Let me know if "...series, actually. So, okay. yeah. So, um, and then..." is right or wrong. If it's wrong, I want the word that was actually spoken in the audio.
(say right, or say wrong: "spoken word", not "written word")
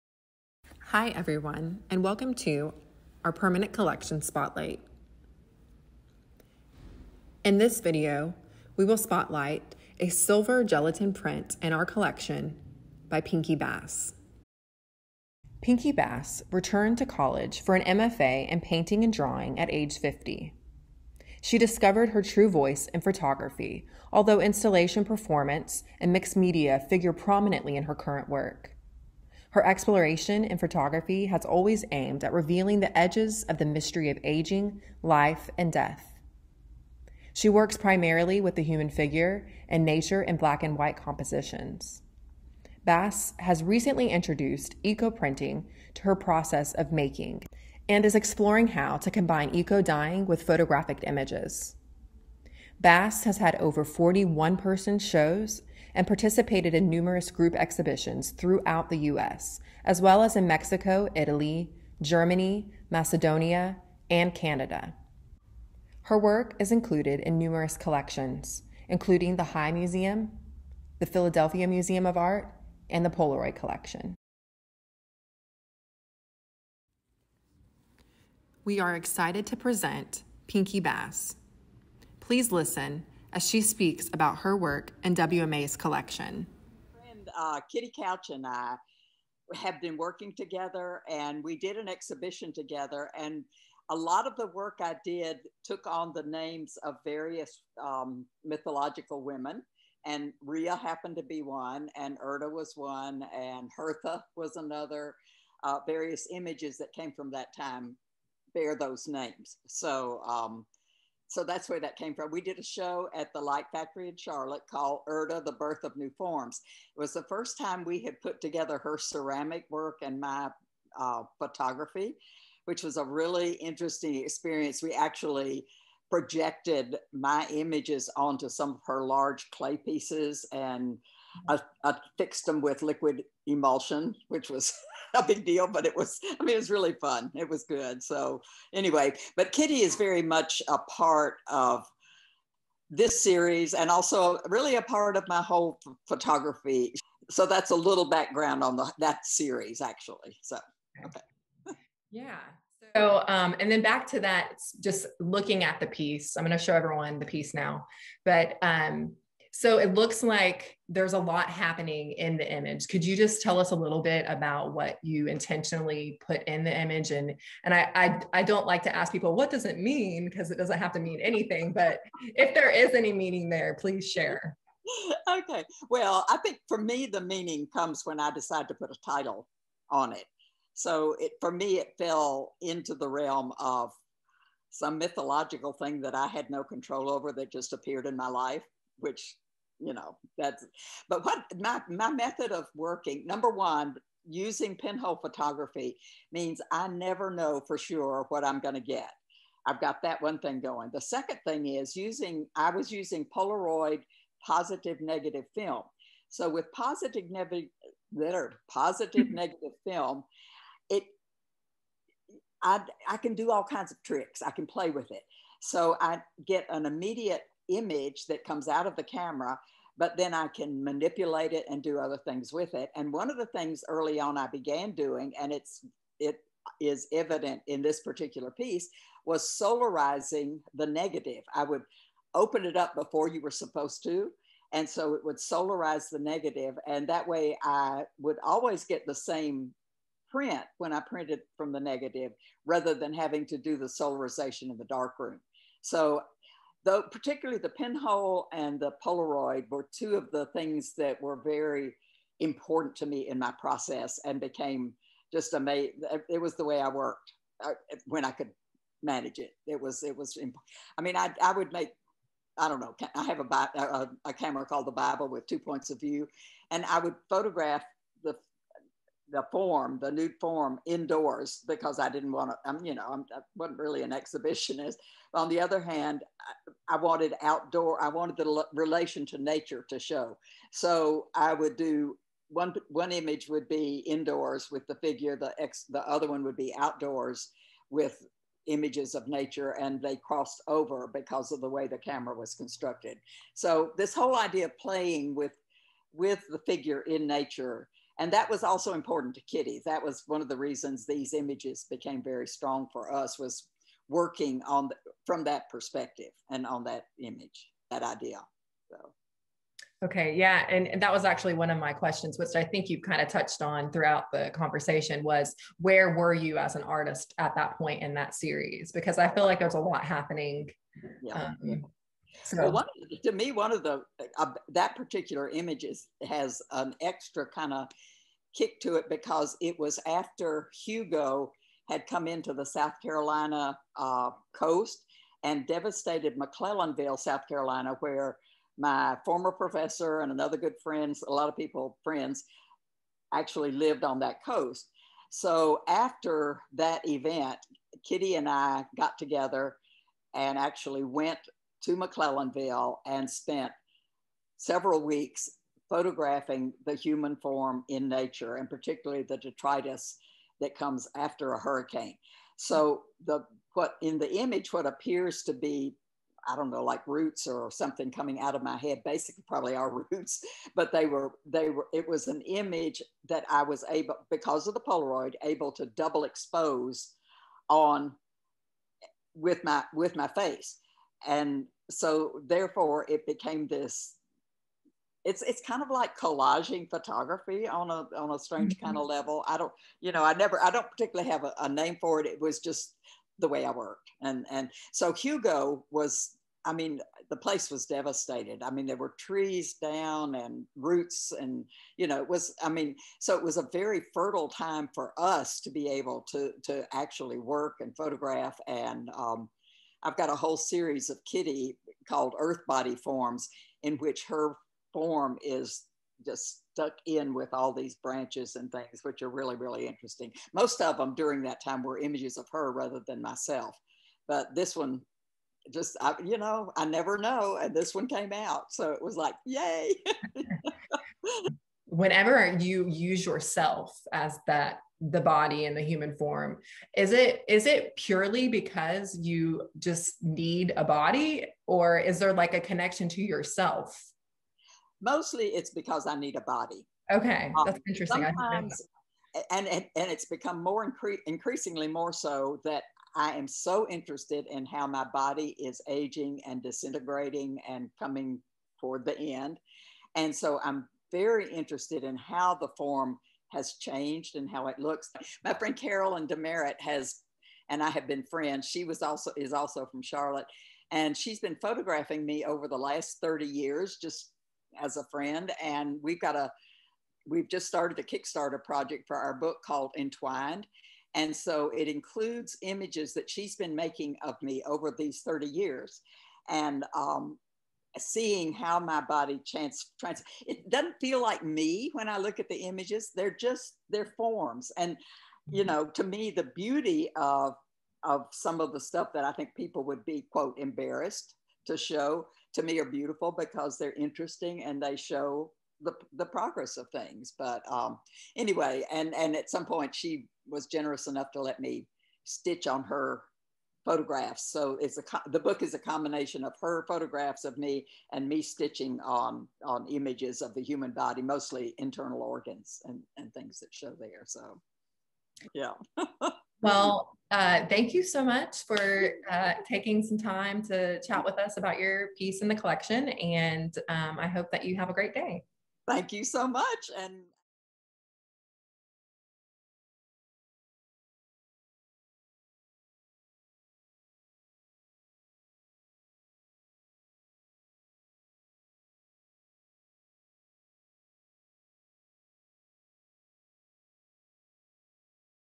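right.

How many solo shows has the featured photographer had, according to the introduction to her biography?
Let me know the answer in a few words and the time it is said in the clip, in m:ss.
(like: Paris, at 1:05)
41, at 0:53.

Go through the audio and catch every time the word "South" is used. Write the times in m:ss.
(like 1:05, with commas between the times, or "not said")
5:32, 5:37.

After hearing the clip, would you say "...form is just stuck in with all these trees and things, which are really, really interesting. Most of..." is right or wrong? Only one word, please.
wrong.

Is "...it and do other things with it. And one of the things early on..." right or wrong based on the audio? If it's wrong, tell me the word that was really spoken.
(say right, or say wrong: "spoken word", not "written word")
right.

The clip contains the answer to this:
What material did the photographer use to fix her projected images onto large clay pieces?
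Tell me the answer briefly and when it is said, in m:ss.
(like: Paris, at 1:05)
Liquid emulsion, at 2:12.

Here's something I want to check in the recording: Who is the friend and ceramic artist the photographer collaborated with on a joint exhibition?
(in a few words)
Kitty Couch.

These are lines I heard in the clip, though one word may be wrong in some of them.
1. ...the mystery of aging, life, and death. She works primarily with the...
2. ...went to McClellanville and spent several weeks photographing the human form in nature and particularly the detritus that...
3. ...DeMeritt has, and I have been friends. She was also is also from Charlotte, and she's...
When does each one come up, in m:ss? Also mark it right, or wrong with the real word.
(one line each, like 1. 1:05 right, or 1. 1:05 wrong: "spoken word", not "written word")
1. 0:33 right
2. 5:51 right
3. 7:46 right.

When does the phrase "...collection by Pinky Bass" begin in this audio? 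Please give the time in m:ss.
0:11.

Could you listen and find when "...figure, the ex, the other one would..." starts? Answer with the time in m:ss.
4:44.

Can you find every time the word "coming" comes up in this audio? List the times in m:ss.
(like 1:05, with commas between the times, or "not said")
6:08, 7:37.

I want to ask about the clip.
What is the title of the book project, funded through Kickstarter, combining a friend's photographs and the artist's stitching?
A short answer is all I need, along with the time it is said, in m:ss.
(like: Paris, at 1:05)
Entwined, at 7:59.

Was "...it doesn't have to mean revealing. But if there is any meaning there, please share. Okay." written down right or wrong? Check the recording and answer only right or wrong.
wrong.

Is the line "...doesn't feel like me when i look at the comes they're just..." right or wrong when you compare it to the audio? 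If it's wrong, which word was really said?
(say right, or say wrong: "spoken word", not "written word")
wrong: "images", not "comes".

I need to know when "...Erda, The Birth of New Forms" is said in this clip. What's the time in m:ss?
1:55.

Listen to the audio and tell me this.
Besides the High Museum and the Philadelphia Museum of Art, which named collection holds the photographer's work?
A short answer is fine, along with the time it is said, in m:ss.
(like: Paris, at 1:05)
Polaroid Collection, at 1:13.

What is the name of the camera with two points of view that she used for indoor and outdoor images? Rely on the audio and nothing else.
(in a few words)
The Bible.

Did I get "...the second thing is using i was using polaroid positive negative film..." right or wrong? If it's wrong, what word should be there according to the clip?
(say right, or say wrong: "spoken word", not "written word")
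right.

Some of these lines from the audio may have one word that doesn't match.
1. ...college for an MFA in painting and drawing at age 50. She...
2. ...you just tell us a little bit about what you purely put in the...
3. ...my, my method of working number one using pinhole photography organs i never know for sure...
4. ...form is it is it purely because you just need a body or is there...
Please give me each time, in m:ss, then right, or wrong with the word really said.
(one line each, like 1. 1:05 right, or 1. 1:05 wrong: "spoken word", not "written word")
1. 0:17 right
2. 2:43 wrong: "intentionally", not "purely"
3. 3:11 wrong: "means", not "organs"
4. 7:16 right.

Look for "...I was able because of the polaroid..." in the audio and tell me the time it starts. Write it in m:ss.
6:13.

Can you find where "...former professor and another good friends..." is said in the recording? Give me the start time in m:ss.
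5:39.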